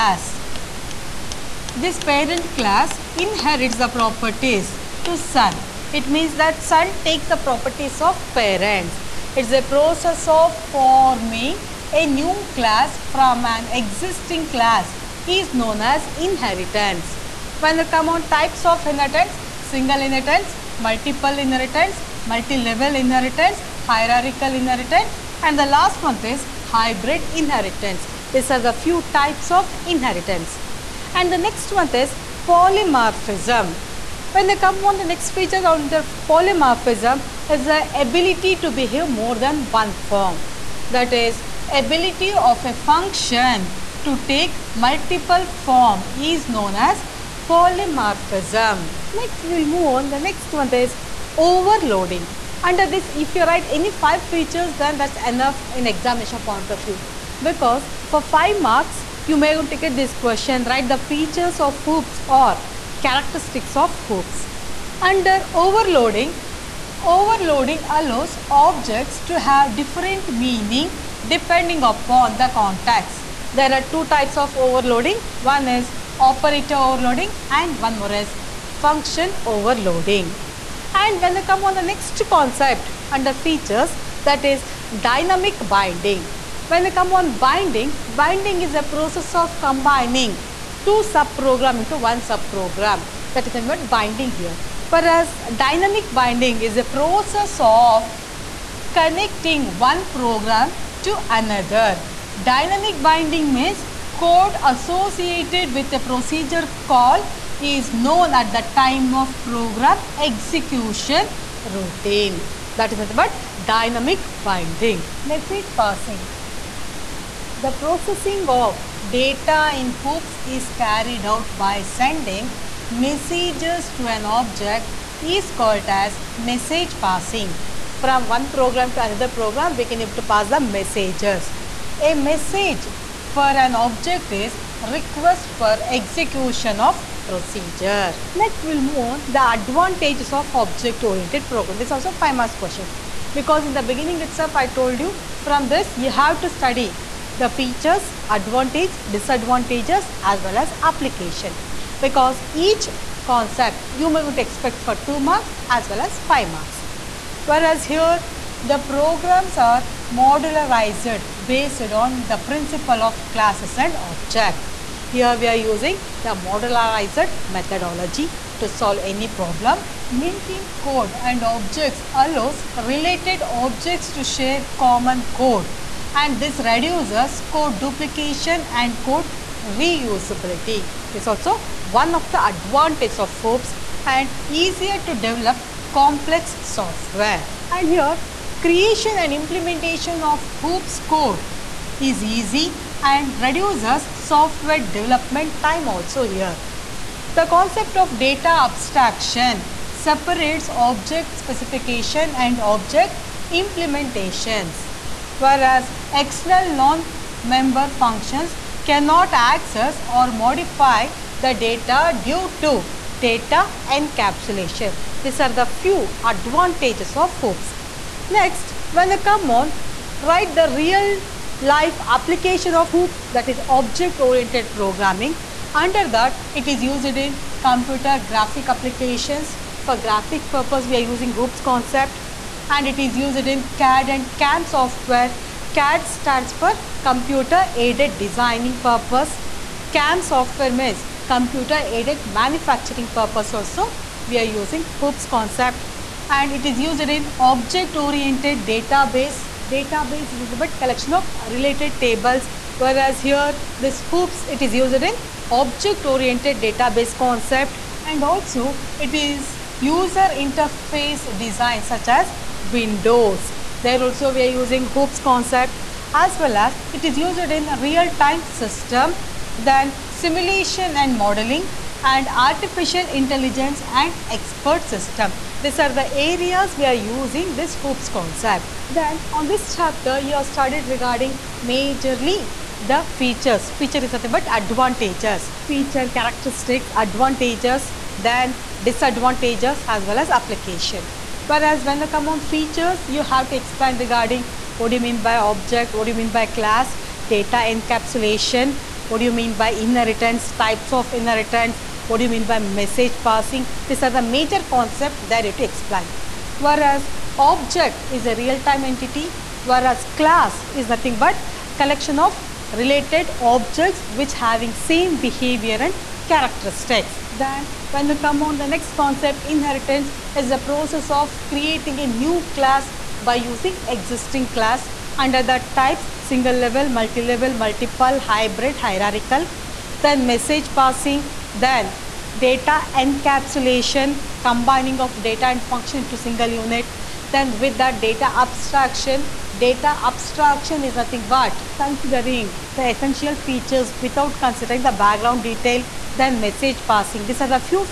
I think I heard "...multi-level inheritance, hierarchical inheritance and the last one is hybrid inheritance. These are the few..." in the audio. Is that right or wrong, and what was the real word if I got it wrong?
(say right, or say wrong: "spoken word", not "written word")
right.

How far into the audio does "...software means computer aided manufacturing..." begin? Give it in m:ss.
4:00.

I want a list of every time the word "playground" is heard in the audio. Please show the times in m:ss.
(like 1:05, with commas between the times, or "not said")
not said.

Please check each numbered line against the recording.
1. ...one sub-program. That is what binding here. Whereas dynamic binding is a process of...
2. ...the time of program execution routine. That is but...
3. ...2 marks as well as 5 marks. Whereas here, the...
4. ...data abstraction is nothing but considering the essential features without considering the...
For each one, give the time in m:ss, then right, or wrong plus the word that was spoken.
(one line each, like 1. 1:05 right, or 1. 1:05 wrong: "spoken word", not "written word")
1. 1:31 right
2. 1:48 right
3. 2:35 right
4. 5:39 right.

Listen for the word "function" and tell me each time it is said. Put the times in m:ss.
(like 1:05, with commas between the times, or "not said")
0:42, 1:18, 3:27, 5:35.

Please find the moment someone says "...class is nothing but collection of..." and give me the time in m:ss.
5:10.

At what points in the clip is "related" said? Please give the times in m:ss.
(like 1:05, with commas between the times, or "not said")
2:52, 4:11, 5:12.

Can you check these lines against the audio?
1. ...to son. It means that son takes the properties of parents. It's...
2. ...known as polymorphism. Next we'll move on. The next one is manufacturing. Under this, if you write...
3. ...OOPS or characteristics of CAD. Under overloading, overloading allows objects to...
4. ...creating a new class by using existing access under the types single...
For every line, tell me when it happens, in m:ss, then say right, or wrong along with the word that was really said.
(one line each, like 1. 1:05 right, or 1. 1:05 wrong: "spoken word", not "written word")
1. 0:05 right
2. 0:46 wrong: "overloading", not "manufacturing"
3. 1:01 wrong: "OOPS", not "CAD"
4. 5:21 wrong: "class", not "access".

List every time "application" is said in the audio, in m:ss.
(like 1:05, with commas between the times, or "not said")
2:30, 3:42, 3:48, 4:50.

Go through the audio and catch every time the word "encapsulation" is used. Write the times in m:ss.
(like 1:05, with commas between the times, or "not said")
3:33, 4:57, 5:32.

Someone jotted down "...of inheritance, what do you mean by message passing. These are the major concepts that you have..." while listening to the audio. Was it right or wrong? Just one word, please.
right.